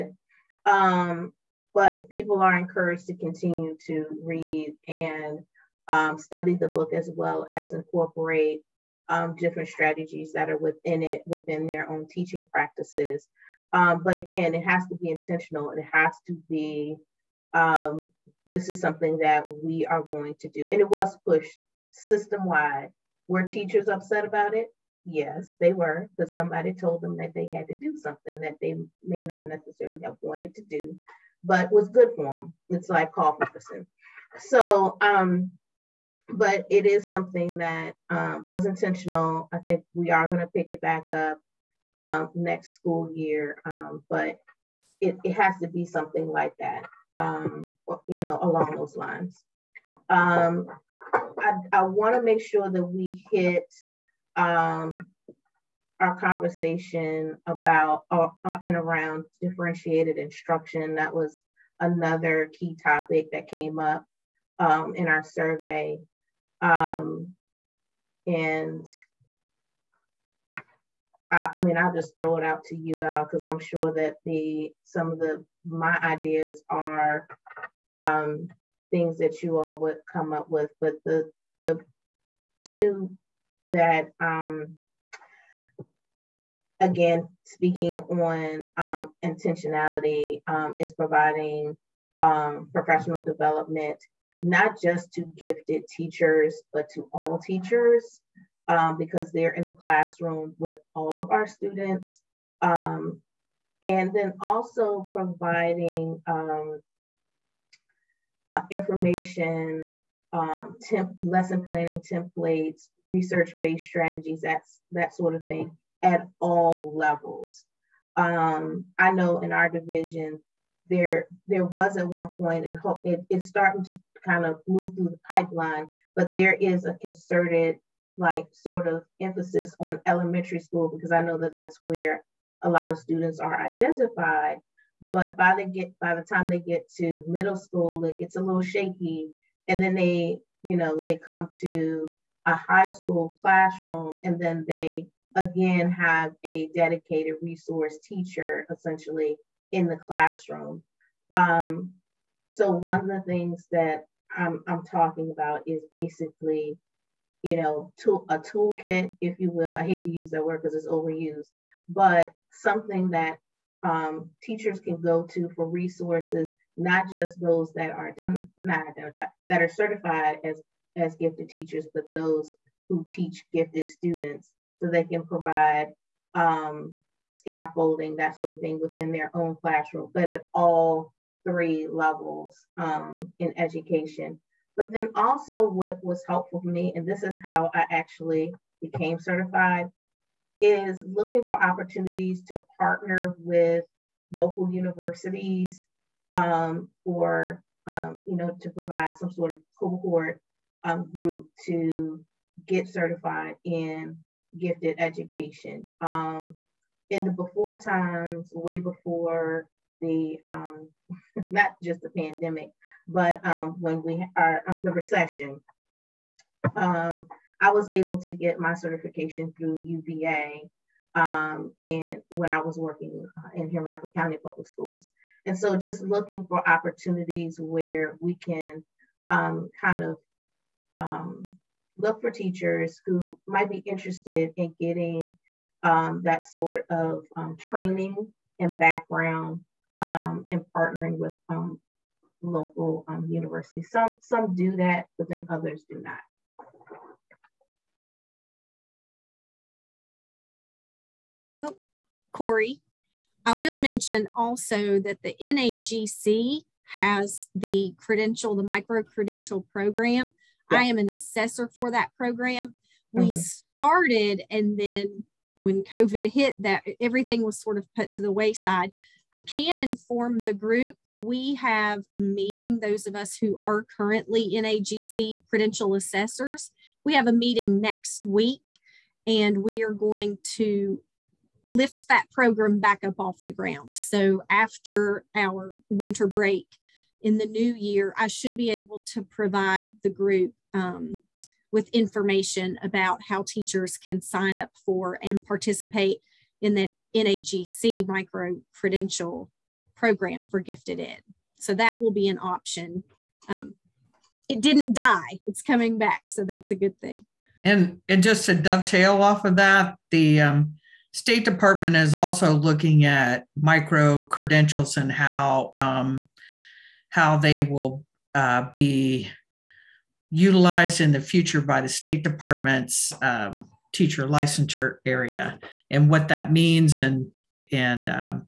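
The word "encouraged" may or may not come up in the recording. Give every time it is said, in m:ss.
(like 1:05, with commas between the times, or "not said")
0:02.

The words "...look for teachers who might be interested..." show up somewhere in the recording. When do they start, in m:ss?
3:51.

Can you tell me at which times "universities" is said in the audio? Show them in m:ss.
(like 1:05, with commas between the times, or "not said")
3:14, 4:03.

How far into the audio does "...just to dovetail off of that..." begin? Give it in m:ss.
5:08.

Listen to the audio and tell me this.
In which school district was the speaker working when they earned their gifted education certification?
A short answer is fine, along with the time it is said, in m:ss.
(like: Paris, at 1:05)
Henrico County Public Schools, at 3:43.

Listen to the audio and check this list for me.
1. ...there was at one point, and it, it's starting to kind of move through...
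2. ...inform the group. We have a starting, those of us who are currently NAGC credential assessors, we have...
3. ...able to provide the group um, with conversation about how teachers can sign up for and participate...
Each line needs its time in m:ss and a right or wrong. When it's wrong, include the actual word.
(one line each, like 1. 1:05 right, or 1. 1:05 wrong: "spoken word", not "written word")
1. 2:01 right
2. 4:29 wrong: "meeting", not "starting"
3. 4:48 wrong: "information", not "conversation".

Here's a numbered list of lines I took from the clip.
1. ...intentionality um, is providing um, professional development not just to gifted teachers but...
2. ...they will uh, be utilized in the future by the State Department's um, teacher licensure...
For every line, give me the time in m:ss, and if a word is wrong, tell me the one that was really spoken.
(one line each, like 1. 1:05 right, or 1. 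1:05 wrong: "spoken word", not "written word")
1. 1:29 right
2. 5:17 right.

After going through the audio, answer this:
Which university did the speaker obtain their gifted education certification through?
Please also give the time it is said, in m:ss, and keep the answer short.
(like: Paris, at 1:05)
UVA, at 3:39.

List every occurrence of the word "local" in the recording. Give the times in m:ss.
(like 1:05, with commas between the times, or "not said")
3:14, 4:02.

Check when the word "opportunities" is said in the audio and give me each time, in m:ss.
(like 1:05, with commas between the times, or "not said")
3:11, 3:46.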